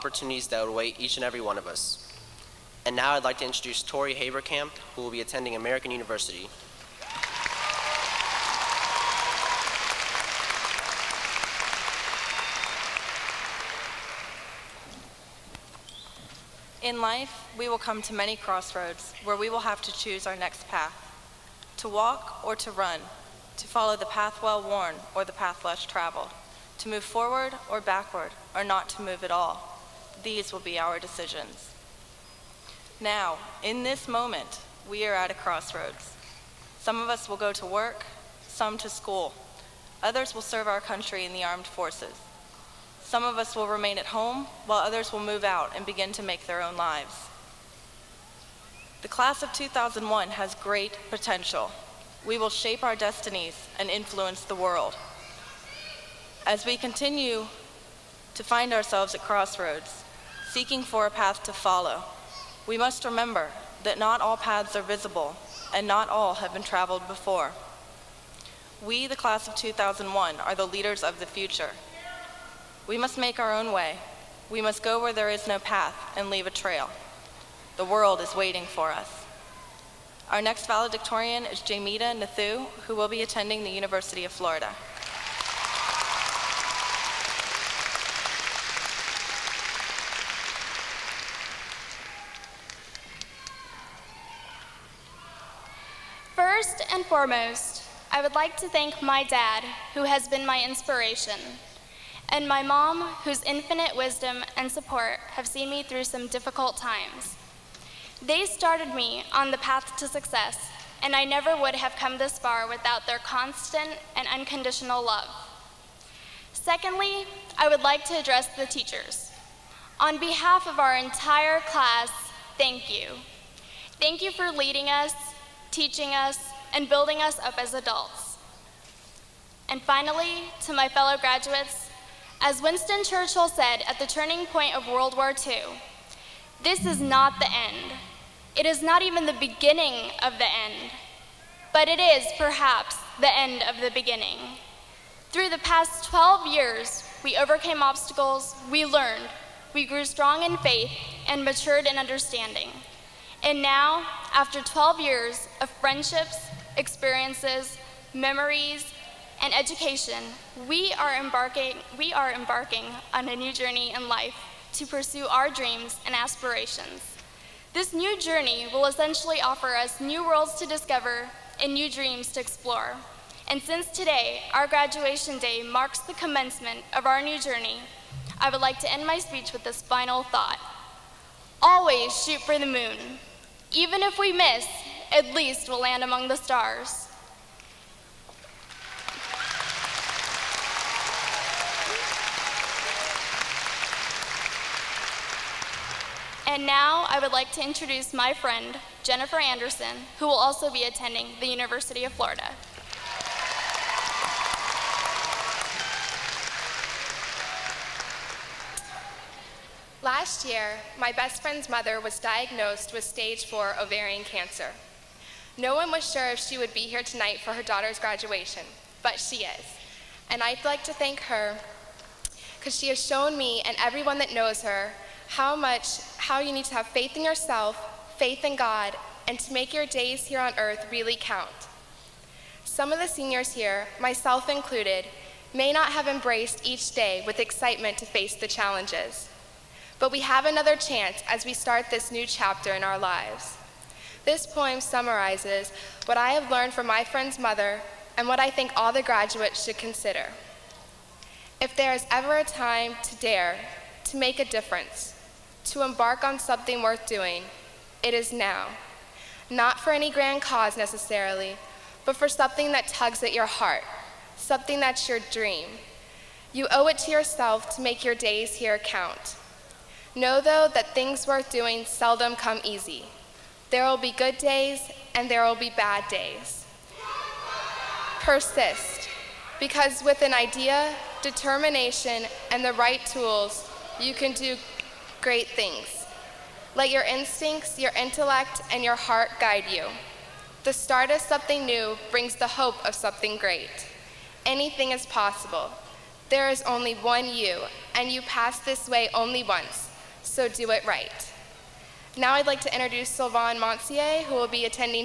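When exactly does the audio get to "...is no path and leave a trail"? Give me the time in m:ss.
1:15.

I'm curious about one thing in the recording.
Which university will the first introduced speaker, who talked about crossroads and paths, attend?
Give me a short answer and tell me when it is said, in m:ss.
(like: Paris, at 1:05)
American University, at 0:05.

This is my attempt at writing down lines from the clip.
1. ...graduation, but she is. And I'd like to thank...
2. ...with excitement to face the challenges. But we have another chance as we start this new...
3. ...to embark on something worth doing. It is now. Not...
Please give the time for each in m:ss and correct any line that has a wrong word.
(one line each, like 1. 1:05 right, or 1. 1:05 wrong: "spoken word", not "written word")
1. 3:37 right
2. 3:57 right
3. 4:15 right.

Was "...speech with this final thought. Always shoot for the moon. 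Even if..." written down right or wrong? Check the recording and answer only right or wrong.
right.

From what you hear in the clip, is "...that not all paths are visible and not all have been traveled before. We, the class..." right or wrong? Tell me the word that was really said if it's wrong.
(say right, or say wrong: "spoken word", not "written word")
right.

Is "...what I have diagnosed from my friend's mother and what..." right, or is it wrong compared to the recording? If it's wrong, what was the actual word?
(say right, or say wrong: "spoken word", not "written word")
wrong: "learned", not "diagnosed".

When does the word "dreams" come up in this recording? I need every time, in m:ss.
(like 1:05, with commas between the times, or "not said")
2:45, 2:51, 4:25.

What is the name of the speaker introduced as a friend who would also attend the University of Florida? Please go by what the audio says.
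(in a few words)
Jennifer Anderson.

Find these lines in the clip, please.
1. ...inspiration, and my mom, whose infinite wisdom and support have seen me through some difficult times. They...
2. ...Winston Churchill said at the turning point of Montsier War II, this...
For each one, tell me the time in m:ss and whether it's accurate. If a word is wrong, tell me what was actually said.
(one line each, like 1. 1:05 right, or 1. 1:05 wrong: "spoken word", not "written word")
1. 1:40 right
2. 2:12 wrong: "World", not "Montsier".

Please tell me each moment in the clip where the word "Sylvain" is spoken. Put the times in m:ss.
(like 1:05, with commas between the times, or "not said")
5:03.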